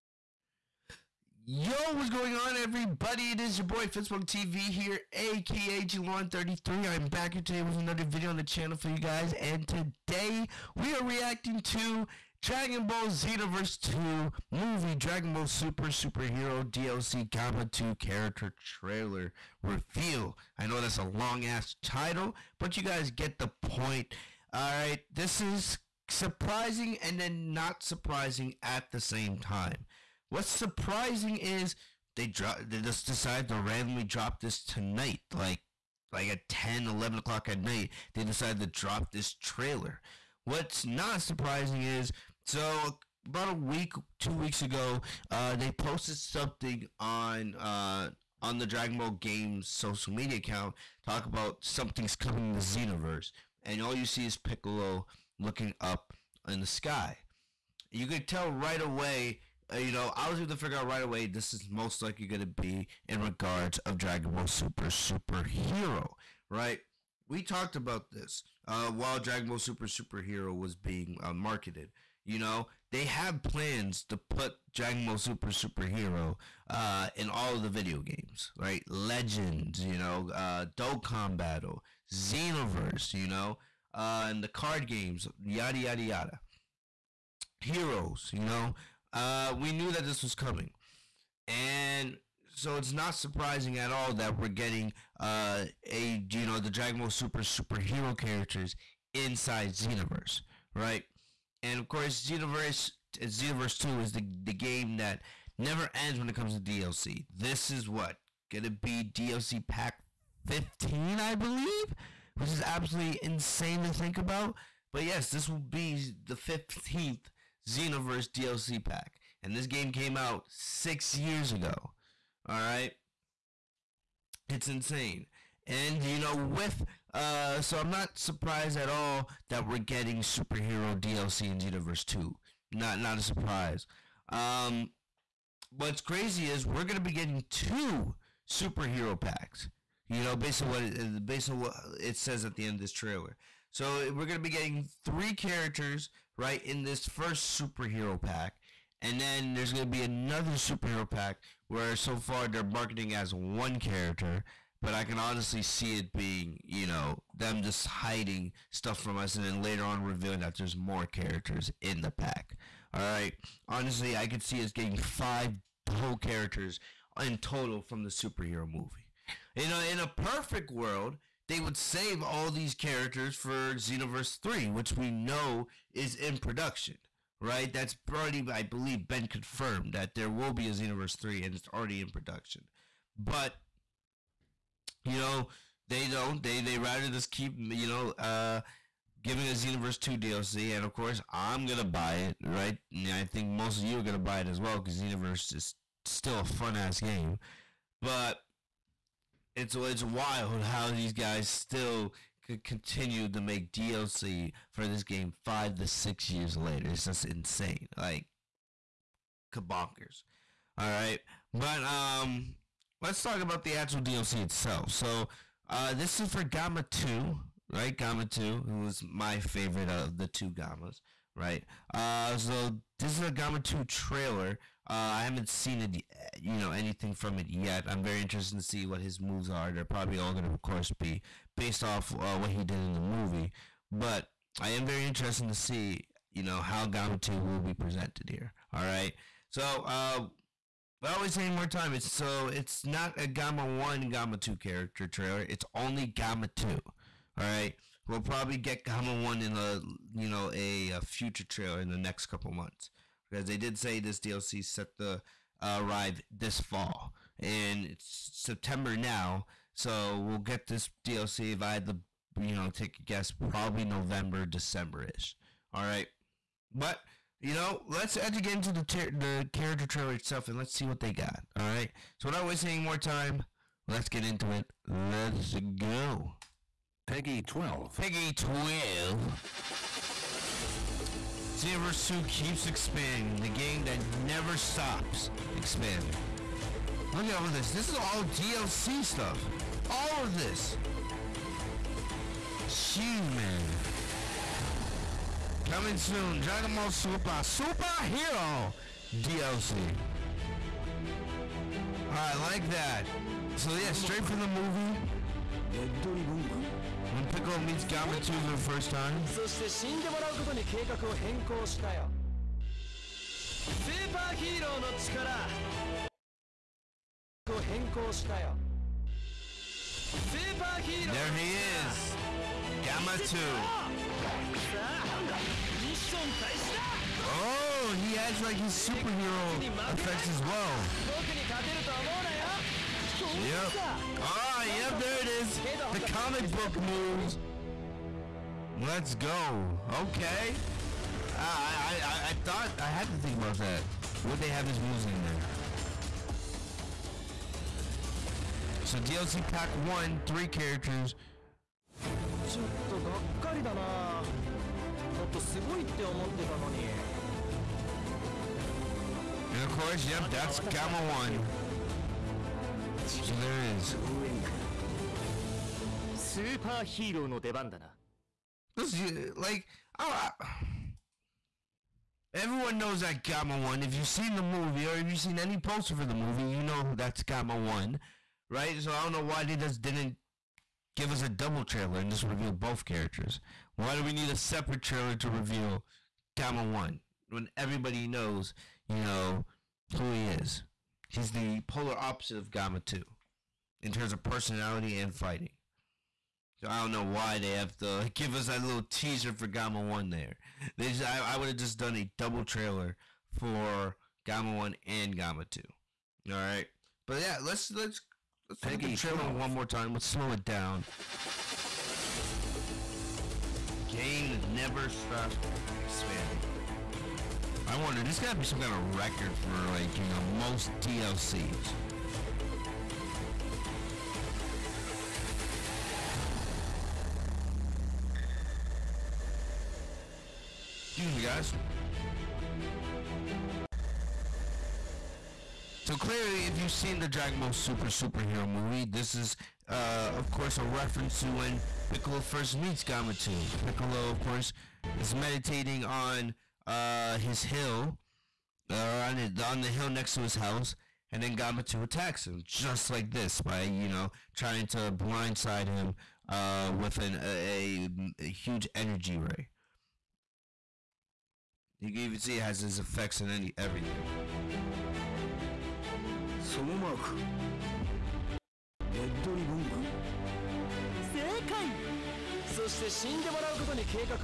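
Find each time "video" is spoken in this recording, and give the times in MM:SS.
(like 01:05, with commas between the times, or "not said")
00:08, 01:17.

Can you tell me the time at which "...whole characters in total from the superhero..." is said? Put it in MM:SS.
02:45.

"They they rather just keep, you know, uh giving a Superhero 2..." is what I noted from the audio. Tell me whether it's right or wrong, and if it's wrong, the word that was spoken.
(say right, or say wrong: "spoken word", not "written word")
wrong: "Xenoverse", not "Superhero".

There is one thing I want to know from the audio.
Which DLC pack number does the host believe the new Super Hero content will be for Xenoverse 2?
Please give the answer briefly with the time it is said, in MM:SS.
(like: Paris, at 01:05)
15, at 01:50.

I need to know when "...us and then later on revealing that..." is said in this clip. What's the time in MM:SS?
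02:39.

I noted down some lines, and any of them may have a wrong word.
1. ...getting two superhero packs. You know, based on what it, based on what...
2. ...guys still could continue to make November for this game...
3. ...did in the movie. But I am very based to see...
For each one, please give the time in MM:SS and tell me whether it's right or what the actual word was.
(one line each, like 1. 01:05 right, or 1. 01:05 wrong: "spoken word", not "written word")
1. 02:17 right
2. 03:21 wrong: "DLC", not "November"
3. 03:52 wrong: "interested", not "based".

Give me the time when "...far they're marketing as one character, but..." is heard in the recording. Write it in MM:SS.
02:32.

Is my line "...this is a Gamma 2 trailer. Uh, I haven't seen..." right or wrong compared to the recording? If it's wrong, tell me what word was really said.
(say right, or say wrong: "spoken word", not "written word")
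right.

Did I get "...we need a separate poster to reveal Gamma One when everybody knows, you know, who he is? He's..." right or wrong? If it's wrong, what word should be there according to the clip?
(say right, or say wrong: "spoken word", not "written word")
wrong: "trailer", not "poster".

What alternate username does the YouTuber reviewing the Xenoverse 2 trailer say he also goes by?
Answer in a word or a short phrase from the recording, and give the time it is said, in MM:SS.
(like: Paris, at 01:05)
Glorin33, at 00:05.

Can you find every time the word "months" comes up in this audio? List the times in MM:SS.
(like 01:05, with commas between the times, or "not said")
04:12.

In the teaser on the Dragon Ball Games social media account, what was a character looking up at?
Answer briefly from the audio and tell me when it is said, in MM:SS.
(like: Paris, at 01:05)
the sky, at 00:56.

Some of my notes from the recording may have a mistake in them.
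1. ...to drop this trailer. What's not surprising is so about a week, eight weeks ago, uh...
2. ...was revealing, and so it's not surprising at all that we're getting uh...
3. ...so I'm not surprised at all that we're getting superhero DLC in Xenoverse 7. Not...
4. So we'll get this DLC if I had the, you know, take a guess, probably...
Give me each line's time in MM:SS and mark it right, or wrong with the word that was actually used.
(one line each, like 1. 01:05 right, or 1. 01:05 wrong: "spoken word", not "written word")
1. 00:38 wrong: "two", not "eight"
2. 01:30 wrong: "coming", not "revealing"
3. 02:07 wrong: "2", not "7"
4. 04:19 right.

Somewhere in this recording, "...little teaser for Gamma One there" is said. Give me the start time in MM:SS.
06:38.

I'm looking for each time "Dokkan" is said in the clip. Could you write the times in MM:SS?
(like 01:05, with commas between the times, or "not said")
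01:20.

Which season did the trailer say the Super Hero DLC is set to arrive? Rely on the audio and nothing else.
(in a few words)
fall.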